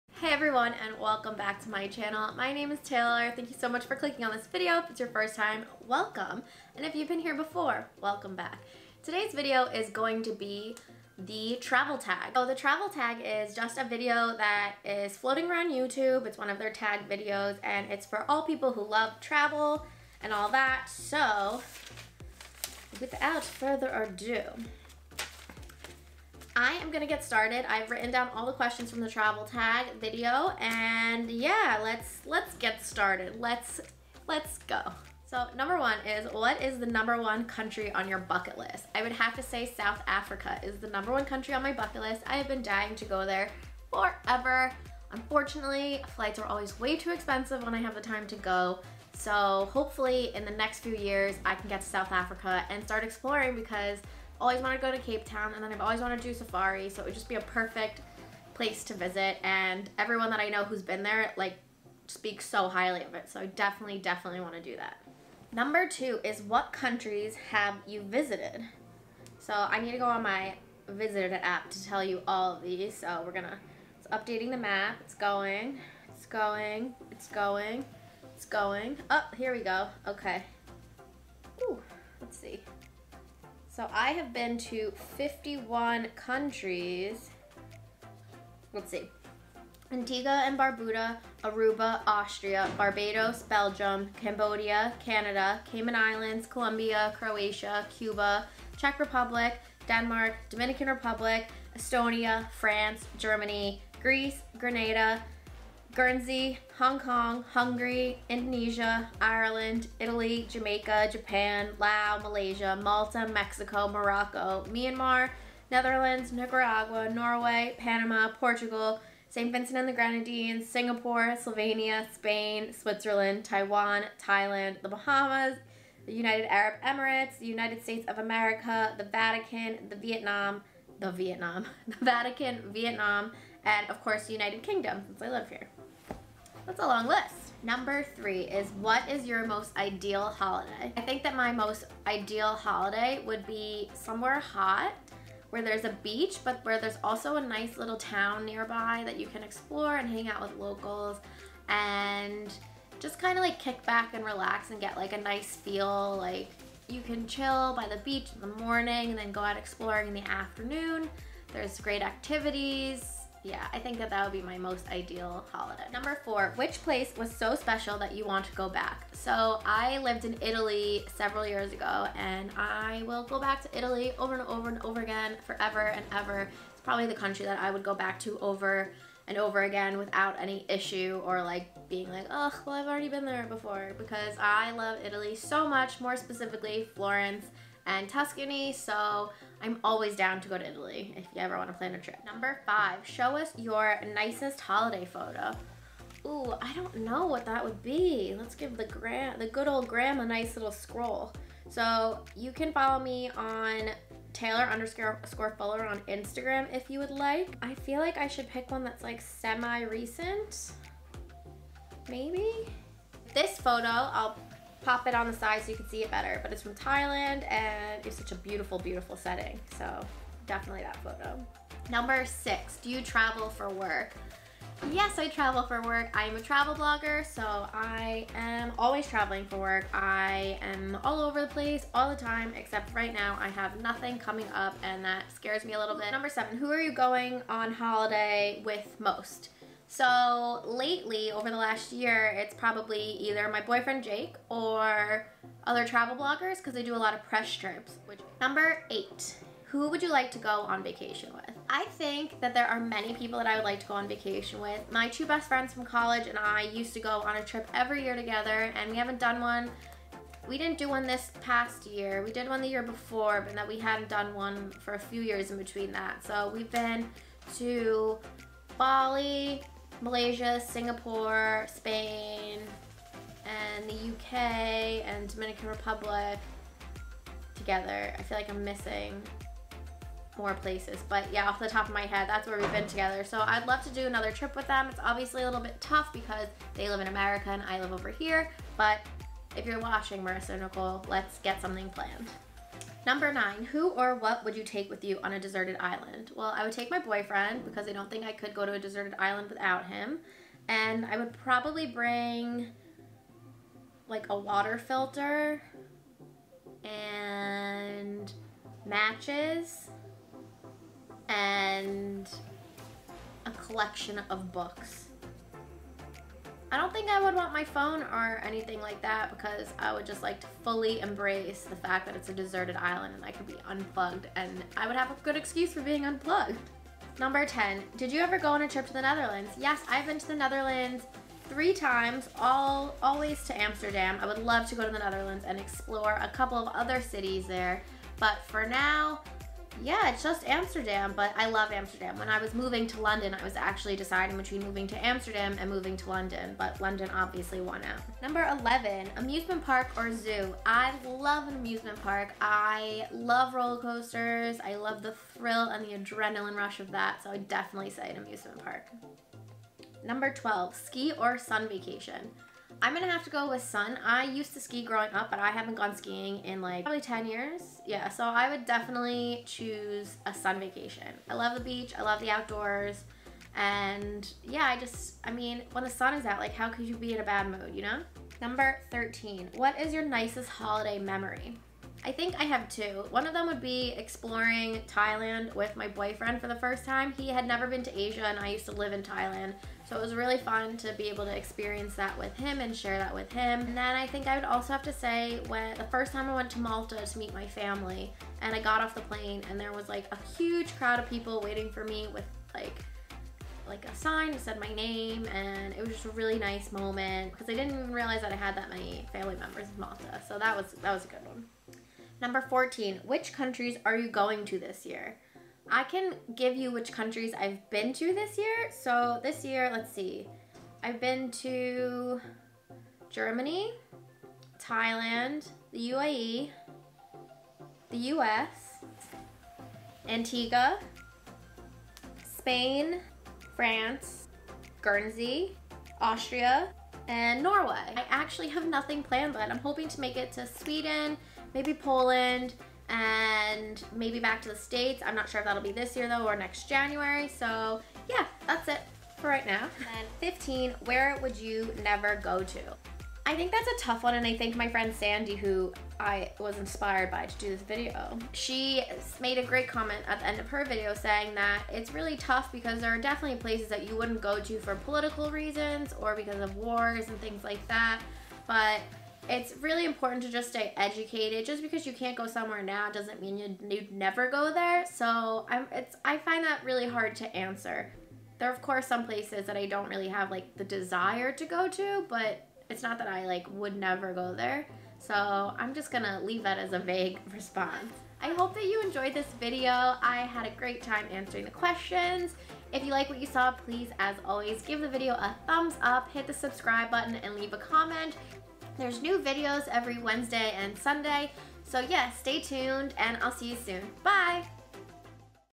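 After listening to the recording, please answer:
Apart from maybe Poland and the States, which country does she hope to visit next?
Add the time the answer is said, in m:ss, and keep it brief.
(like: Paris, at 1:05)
Sweden, at 7:20.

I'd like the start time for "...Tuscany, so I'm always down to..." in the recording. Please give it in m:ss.
3:08.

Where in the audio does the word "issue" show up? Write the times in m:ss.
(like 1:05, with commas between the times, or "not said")
3:00.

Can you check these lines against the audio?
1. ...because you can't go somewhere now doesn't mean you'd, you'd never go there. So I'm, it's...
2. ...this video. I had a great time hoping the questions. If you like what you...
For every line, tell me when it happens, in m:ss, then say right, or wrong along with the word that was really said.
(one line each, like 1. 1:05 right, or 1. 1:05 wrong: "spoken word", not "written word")
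1. 7:51 right
2. 8:09 wrong: "answering", not "hoping".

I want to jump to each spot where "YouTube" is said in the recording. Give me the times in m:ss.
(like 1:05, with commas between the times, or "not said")
0:15.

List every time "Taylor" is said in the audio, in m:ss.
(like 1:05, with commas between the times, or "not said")
0:02, 3:24.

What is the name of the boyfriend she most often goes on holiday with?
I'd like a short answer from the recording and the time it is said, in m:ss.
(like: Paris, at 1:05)
Jake, at 4:04.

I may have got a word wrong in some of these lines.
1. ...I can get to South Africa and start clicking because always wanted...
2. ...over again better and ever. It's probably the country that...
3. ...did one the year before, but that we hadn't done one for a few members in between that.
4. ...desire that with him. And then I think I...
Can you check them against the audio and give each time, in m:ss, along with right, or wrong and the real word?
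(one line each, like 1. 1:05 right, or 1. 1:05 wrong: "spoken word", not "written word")
1. 0:51 wrong: "exploring", not "clicking"
2. 2:54 wrong: "forever", not "better"
3. 4:22 wrong: "years", not "members"
4. 6:32 wrong: "share", not "desire".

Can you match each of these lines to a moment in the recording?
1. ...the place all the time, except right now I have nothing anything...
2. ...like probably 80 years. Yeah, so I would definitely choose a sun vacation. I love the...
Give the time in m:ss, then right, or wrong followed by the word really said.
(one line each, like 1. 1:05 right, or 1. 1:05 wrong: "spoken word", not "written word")
1. 3:51 wrong: "coming", not "anything"
2. 6:06 wrong: "10", not "80".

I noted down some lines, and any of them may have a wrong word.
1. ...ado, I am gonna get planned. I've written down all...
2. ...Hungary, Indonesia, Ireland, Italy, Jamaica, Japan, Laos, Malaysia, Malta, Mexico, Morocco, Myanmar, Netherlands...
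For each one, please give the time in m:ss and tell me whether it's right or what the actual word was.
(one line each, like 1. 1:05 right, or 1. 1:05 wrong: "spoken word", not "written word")
1. 0:23 wrong: "started", not "planned"
2. 1:47 right.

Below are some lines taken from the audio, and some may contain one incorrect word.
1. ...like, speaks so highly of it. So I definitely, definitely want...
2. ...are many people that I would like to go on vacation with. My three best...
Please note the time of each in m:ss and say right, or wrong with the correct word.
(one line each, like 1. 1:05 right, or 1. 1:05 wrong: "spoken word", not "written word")
1. 1:01 right
2. 4:12 wrong: "two", not "three".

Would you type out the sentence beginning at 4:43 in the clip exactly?
So I'd love to do another trip with them.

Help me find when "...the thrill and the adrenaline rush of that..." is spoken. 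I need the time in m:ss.
5:55.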